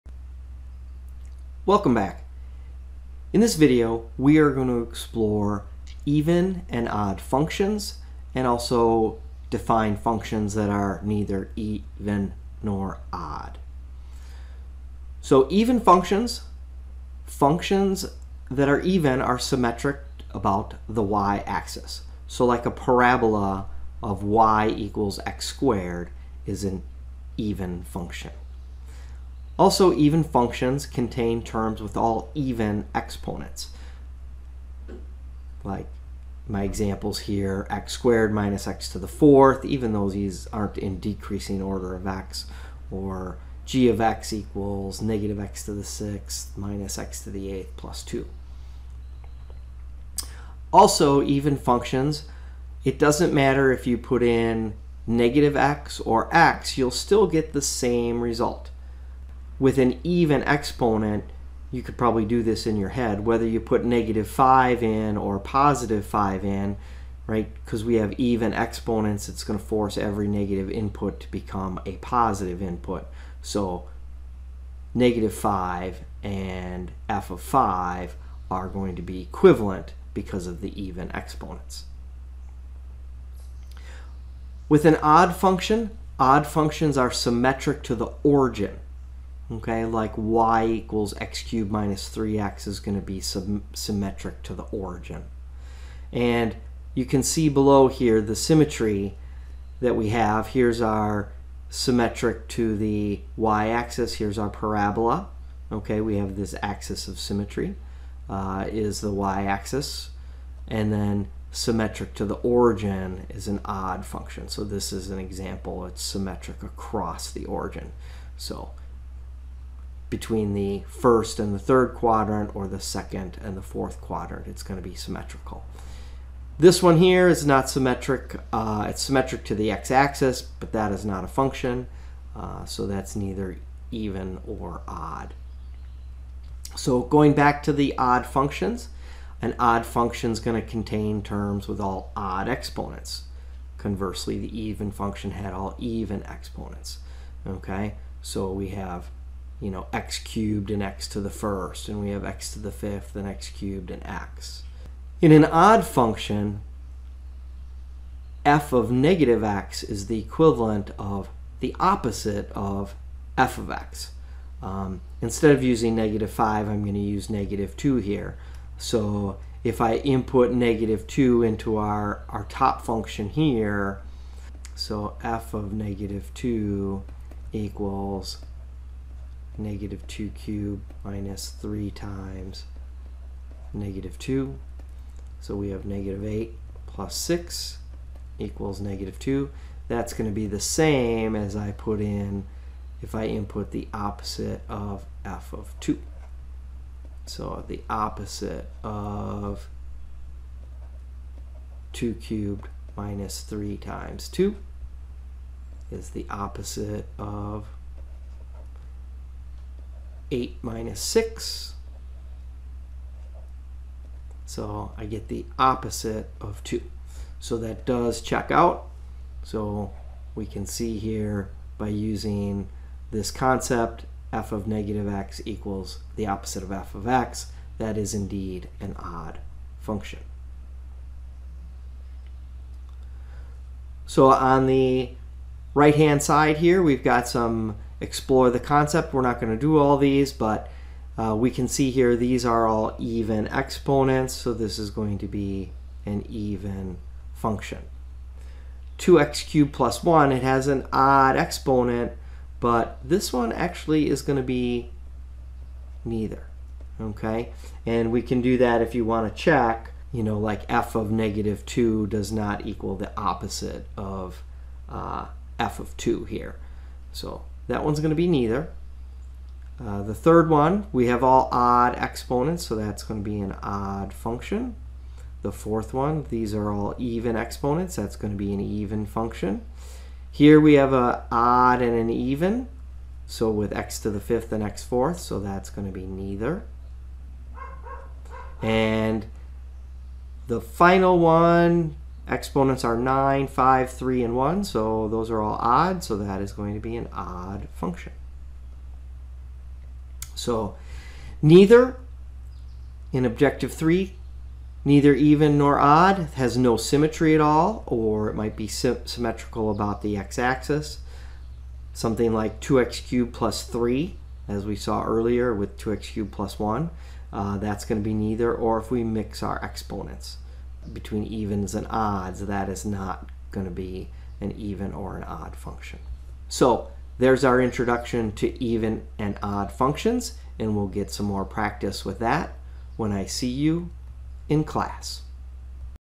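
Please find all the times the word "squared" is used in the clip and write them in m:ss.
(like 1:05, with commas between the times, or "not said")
0:25, 0:37.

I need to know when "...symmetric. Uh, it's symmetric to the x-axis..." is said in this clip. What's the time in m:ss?
2:07.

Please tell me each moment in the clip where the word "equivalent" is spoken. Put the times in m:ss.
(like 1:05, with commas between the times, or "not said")
1:19, 2:40.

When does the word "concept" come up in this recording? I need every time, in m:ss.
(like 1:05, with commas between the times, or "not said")
3:43, 3:58.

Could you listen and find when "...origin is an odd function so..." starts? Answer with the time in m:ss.
1:52.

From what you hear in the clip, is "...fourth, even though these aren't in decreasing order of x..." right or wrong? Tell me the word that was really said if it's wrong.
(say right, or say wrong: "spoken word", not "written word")
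right.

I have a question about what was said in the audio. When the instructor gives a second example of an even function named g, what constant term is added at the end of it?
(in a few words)
2.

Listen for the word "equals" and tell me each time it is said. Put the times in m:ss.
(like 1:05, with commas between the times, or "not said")
0:24, 0:44, 1:30, 2:57, 3:08, 3:45, 4:22.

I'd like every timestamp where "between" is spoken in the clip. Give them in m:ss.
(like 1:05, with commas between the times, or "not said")
2:00, 5:20.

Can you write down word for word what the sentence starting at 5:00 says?
So neither in objective 3, neither even nor odd has no symmetry at all, or it might be symmetrical about the x-axis.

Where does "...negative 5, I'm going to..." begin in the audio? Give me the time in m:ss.
2:45.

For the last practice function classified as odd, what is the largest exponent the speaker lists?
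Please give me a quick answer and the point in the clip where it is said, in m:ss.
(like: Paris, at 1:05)
9, at 4:52.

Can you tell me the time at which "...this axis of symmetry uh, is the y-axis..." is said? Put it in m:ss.
1:46.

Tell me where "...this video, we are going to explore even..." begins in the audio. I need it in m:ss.
0:03.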